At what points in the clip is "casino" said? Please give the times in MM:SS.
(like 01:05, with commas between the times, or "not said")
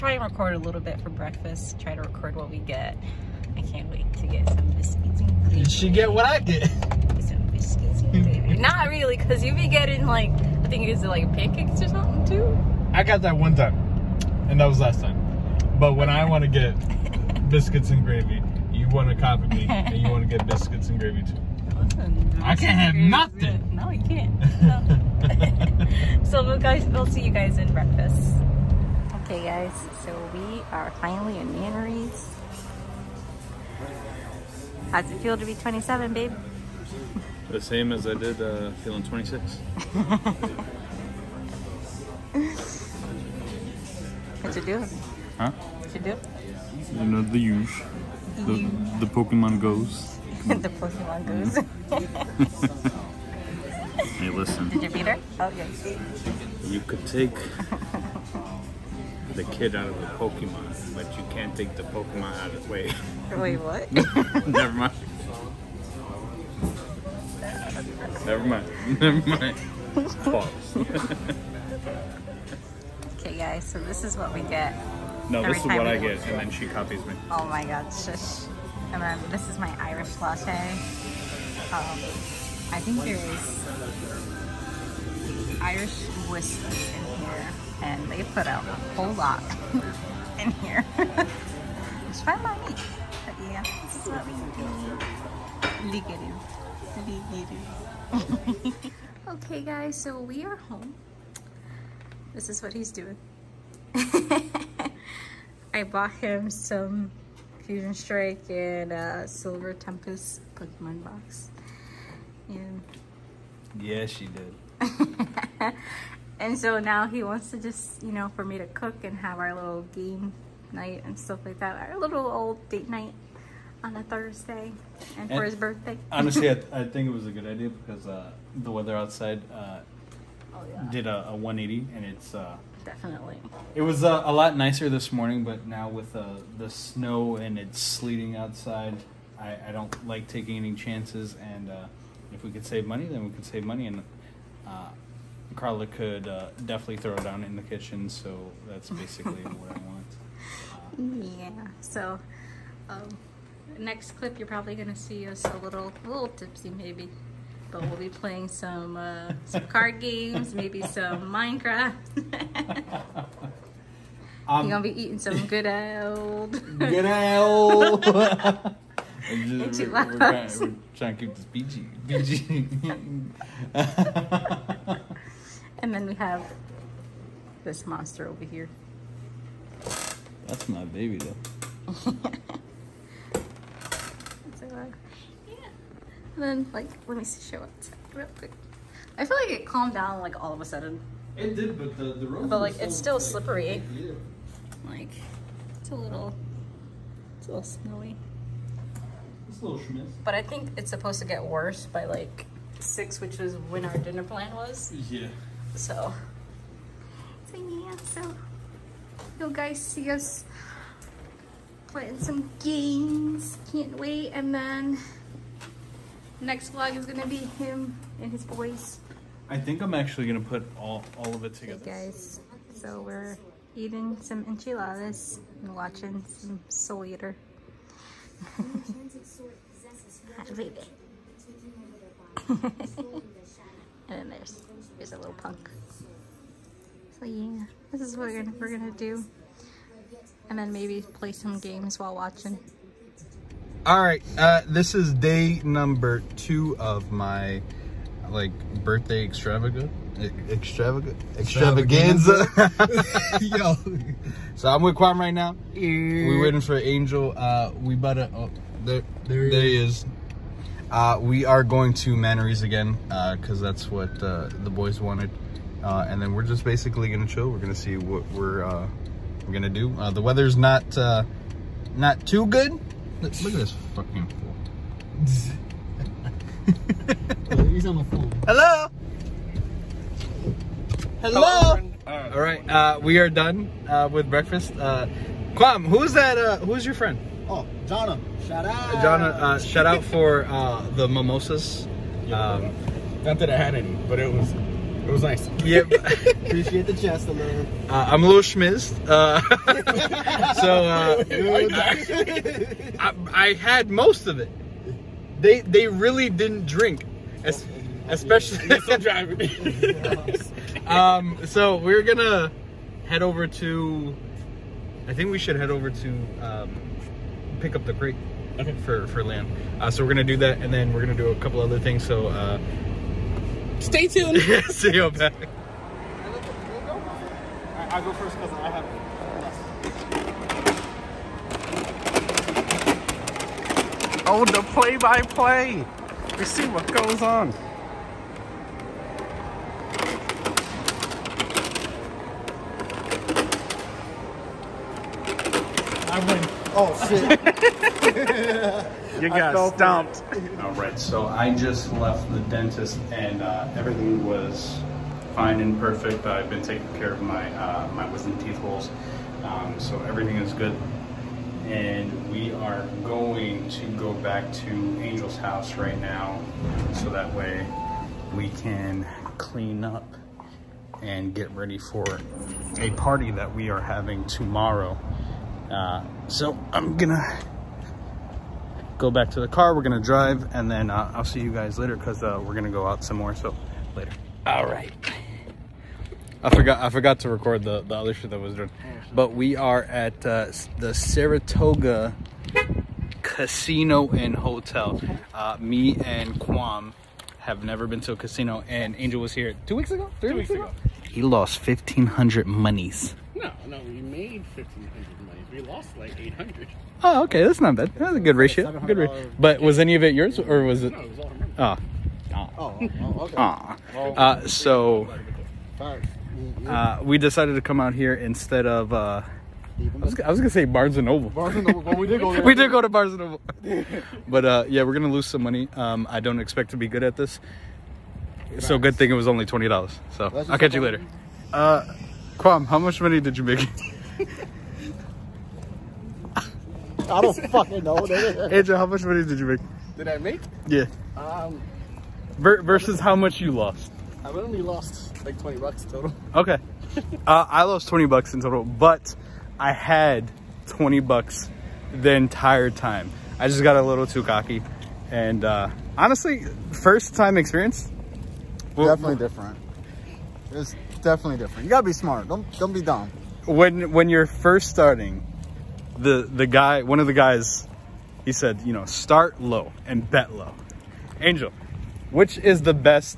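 06:33, 06:38.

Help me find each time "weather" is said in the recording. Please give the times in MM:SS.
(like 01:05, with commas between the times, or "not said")
02:08, 04:30.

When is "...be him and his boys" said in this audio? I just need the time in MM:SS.
03:37.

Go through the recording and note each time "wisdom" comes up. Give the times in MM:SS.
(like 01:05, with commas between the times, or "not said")
05:58.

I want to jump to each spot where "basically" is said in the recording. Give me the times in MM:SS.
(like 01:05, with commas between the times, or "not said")
02:28, 04:26.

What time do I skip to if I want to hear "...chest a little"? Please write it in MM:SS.
04:56.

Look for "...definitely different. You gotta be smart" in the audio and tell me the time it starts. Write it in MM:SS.
07:41.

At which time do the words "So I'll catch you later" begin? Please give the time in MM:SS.
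07:10.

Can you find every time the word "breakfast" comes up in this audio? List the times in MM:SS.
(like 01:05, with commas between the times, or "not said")
00:01, 00:27, 04:44.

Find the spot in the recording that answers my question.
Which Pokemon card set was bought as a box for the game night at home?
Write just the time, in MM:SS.
01:47.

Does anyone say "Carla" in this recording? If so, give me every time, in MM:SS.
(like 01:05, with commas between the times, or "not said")
02:25.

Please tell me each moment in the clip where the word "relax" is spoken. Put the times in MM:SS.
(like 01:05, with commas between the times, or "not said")
not said.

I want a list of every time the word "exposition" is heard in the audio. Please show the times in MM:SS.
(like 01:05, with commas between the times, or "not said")
not said.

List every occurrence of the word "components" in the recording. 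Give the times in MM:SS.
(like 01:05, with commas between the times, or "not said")
not said.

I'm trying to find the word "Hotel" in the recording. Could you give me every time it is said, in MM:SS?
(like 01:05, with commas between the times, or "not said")
06:34.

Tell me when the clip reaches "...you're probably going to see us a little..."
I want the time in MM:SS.
02:34.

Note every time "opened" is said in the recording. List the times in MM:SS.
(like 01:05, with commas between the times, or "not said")
not said.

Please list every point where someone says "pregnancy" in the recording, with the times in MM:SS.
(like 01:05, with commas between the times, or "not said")
not said.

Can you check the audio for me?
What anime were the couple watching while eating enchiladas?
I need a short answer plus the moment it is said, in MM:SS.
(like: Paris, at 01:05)
Soul Eater, at 03:46.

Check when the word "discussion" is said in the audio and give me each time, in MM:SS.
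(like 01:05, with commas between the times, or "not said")
not said.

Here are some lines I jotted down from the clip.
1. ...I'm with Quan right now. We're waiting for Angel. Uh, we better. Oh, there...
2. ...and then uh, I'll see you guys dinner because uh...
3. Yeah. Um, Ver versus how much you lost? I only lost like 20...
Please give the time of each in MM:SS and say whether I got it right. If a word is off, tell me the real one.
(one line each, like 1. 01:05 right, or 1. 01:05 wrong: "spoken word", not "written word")
1. 04:14 right
2. 06:20 wrong: "later", not "dinner"
3. 07:20 right.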